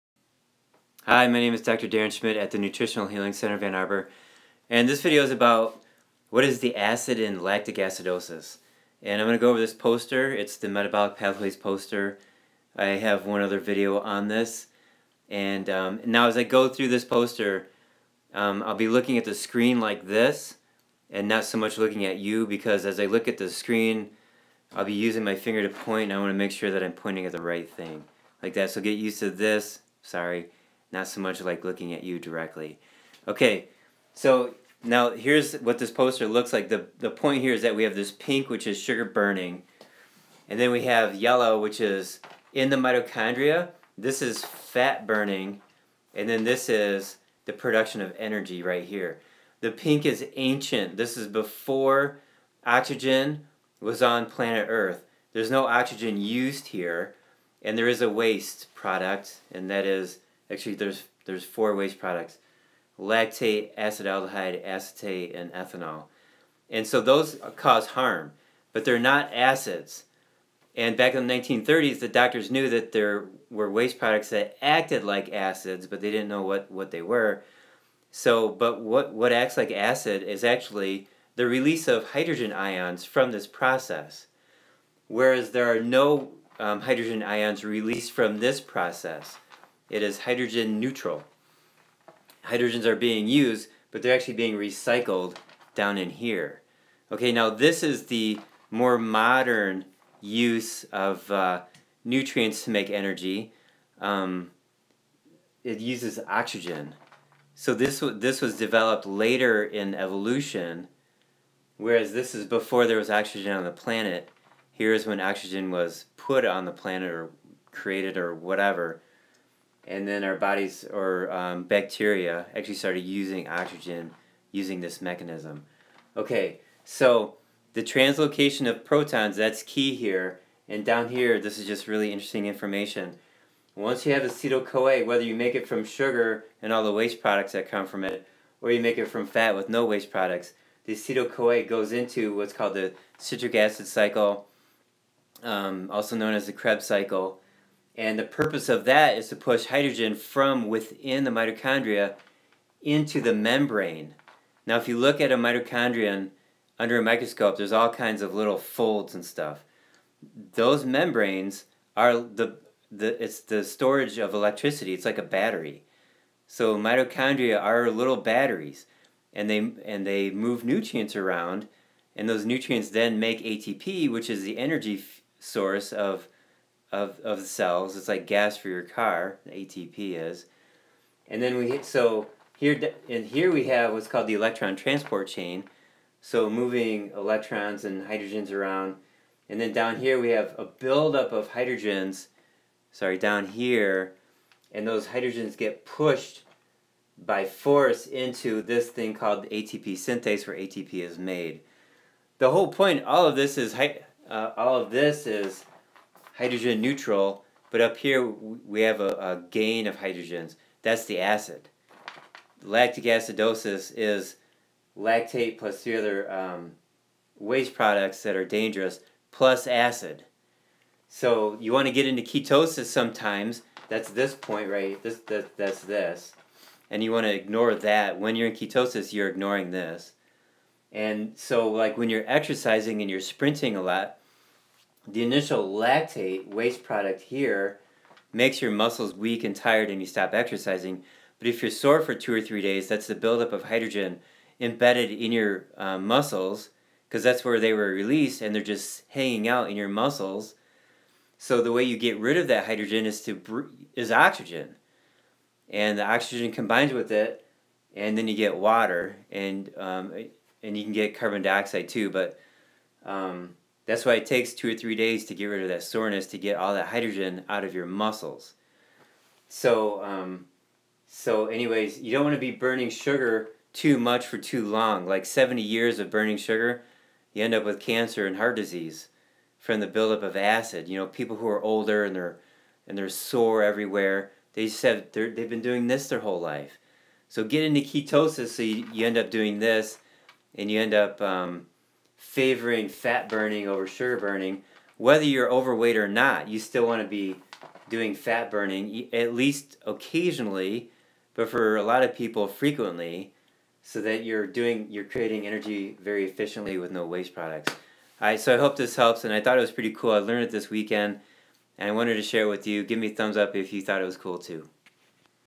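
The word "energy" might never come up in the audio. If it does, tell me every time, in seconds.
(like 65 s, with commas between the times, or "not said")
48 s, 102 s, 174 s, 305 s.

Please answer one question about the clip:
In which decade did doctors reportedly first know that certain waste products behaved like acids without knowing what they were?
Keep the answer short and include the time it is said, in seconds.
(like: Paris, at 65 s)
1930s, at 71 s.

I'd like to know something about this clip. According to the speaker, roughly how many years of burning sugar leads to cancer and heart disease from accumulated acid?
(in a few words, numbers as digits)
70.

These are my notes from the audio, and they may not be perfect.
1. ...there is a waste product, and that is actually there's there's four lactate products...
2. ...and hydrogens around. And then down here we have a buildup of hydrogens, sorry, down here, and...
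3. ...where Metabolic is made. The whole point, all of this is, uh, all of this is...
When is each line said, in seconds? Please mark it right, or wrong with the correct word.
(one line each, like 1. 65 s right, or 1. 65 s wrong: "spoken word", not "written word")
1. 57 s wrong: "waste", not "lactate"
2. 187 s right
3. 200 s wrong: "ATP", not "Metabolic".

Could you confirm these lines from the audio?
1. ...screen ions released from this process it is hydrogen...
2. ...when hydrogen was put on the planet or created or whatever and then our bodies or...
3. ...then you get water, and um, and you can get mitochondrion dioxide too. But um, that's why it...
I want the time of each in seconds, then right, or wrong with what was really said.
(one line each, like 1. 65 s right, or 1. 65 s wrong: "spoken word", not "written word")
1. 86 s wrong: "hydrogen", not "screen"
2. 115 s wrong: "oxygen", not "hydrogen"
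3. 258 s wrong: "carbon", not "mitochondrion".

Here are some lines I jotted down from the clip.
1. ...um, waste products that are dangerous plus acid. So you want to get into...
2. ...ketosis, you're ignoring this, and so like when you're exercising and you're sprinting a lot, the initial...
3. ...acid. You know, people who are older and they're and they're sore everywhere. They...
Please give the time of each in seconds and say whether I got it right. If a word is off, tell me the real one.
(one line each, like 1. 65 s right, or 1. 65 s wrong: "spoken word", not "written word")
1. 216 s right
2. 228 s right
3. 280 s right.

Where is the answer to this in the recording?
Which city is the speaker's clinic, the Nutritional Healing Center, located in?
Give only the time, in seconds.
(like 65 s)
3 s.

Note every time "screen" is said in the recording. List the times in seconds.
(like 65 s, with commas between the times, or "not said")
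19 s, 23 s.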